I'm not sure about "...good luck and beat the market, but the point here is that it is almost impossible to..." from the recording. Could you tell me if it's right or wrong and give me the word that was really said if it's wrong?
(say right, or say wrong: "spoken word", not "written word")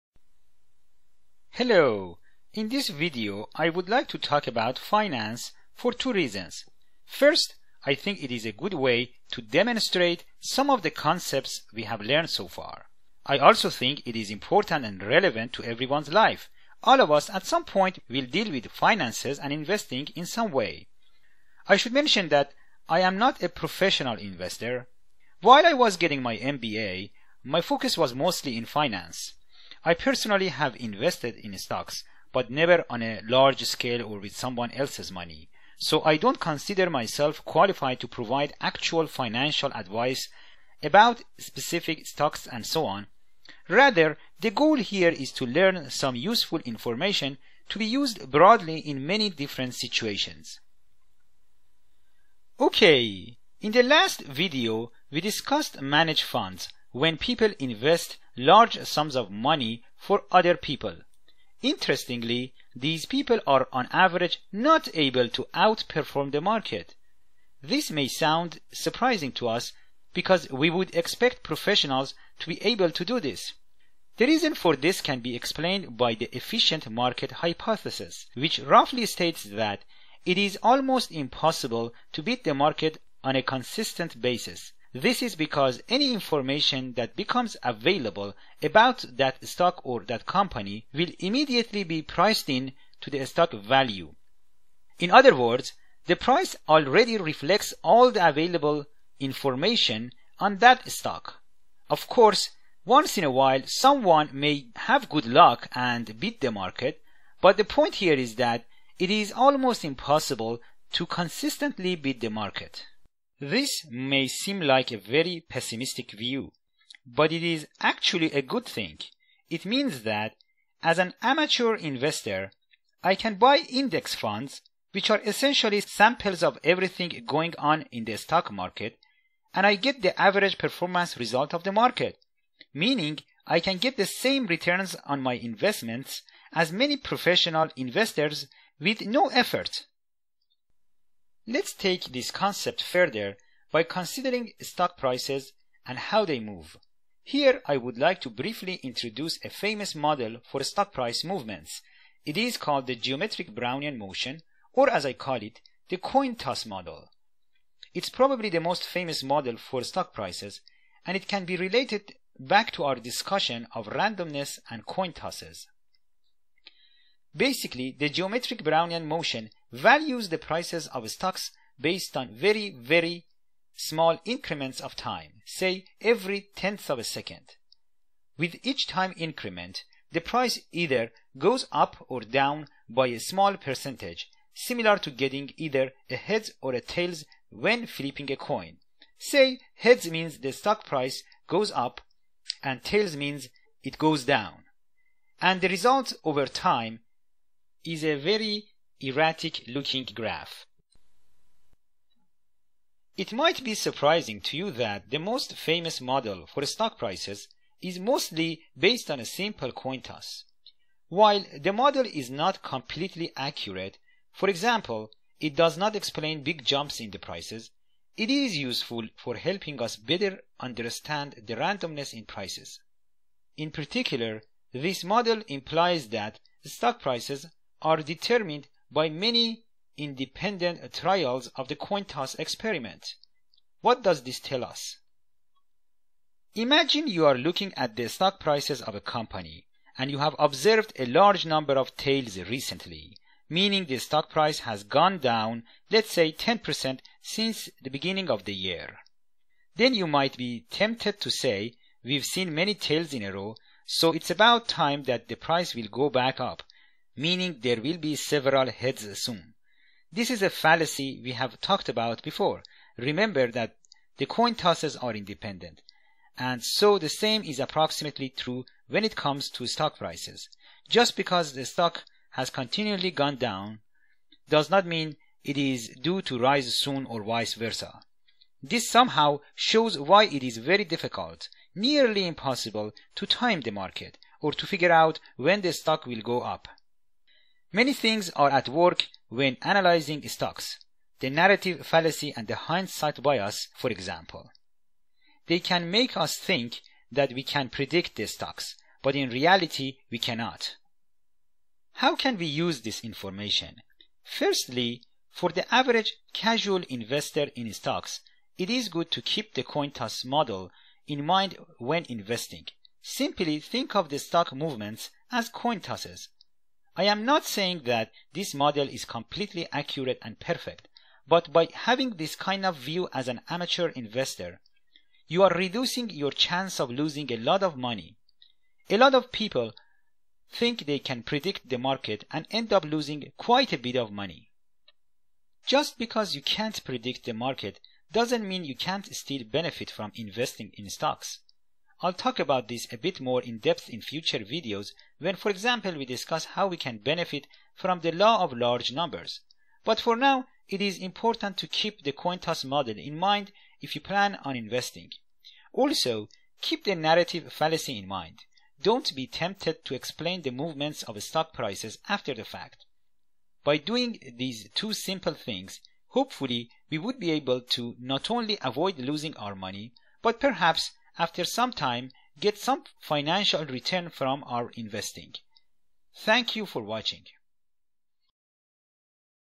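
right.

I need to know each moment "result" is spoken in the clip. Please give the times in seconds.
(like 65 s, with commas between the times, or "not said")
131 s, 195 s.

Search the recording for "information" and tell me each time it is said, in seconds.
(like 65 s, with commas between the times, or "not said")
46 s, 86 s, 99 s, 303 s.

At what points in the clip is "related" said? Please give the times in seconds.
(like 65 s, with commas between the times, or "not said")
161 s.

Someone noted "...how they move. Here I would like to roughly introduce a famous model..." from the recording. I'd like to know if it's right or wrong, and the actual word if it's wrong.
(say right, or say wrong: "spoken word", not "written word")
wrong: "briefly", not "roughly".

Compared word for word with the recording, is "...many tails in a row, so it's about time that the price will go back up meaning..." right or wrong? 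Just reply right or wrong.
right.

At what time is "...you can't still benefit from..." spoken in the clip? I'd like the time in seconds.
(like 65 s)
338 s.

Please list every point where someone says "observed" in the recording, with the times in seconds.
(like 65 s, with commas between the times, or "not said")
240 s.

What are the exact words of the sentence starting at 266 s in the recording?
And so the same is approximately true when it comes to stock prices.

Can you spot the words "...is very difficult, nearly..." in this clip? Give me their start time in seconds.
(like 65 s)
280 s.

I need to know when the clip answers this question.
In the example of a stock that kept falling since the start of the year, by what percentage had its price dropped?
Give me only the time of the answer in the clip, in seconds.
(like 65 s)
246 s.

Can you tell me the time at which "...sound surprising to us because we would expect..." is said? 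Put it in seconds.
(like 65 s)
68 s.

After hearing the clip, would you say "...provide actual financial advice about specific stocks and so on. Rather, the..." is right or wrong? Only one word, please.
right.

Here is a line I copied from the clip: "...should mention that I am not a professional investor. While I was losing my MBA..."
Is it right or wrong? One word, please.
wrong.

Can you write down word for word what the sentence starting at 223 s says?
In particular, this model implies that stock prices are determined by many independent trials of the coin toss experiment.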